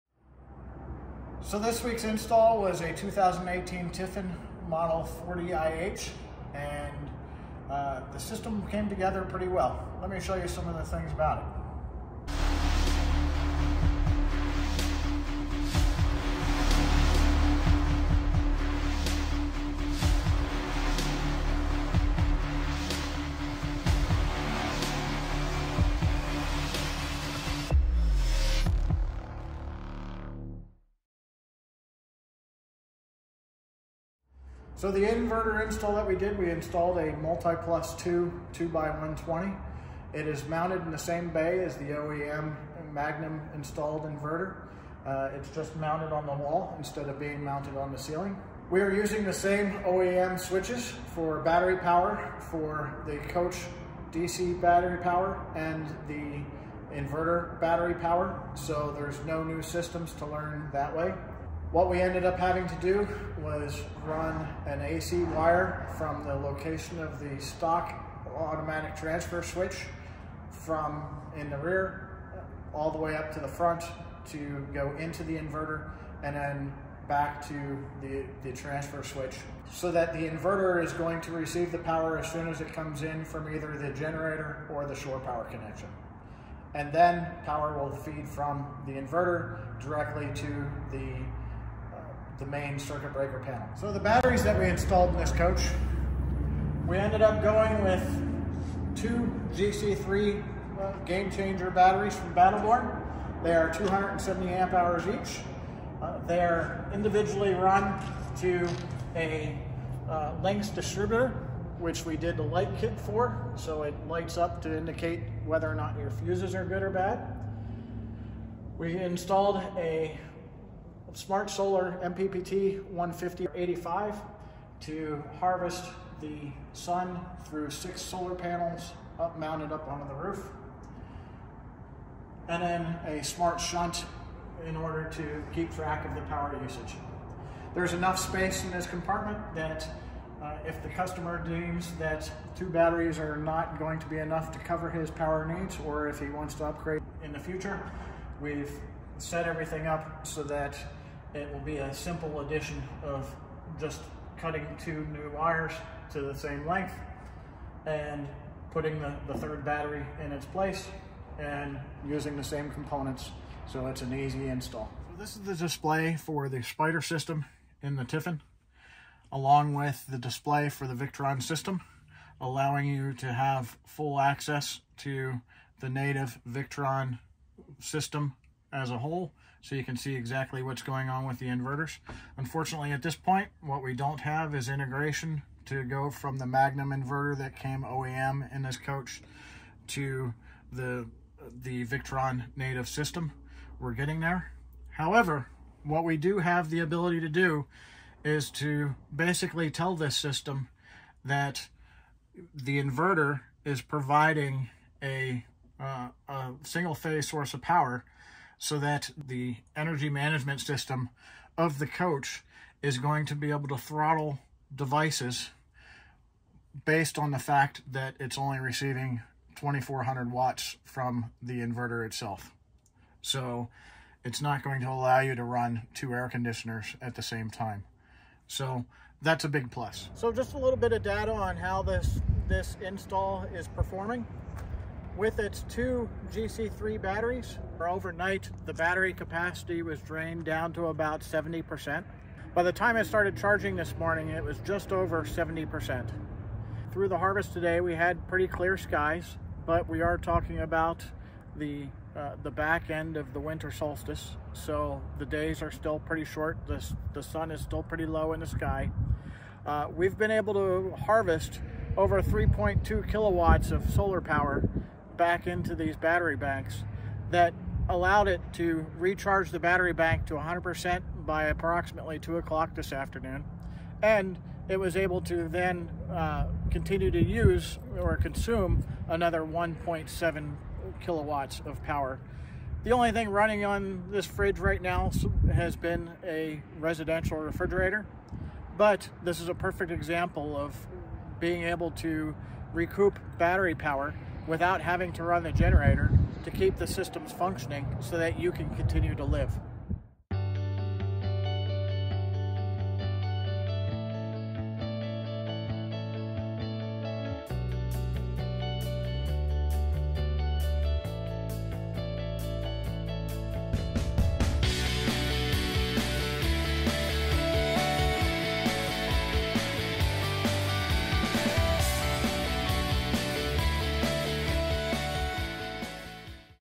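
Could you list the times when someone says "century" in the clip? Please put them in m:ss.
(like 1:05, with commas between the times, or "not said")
not said.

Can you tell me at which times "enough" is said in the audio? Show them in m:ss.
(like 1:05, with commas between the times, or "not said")
2:17, 2:24.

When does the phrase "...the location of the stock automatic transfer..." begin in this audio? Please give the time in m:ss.
1:06.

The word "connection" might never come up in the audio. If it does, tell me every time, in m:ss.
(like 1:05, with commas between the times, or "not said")
1:25.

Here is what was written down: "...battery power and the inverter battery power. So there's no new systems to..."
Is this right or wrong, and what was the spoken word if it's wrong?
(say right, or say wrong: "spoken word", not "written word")
right.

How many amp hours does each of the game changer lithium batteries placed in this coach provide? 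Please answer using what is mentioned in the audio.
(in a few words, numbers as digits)
270.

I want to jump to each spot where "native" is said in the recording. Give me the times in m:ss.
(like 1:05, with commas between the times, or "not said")
2:55, 3:12.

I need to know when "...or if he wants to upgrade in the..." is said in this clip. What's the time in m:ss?
2:25.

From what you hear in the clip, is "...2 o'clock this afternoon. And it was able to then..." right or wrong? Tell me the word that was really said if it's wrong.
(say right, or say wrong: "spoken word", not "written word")
right.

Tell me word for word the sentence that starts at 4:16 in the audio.
The, the sun is still pretty low in the sky.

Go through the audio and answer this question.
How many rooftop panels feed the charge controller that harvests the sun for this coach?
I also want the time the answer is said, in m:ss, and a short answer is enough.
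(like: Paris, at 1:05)
6, at 2:07.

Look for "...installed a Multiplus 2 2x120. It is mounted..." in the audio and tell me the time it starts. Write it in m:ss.
0:36.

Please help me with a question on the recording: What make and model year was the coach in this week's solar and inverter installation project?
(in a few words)
2018 Tiffin.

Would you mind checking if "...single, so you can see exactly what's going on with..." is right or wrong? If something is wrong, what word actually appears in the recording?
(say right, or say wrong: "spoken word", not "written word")
wrong: "whole", not "single".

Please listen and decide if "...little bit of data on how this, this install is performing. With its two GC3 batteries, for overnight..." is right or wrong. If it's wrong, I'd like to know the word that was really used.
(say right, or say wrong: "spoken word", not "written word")
right.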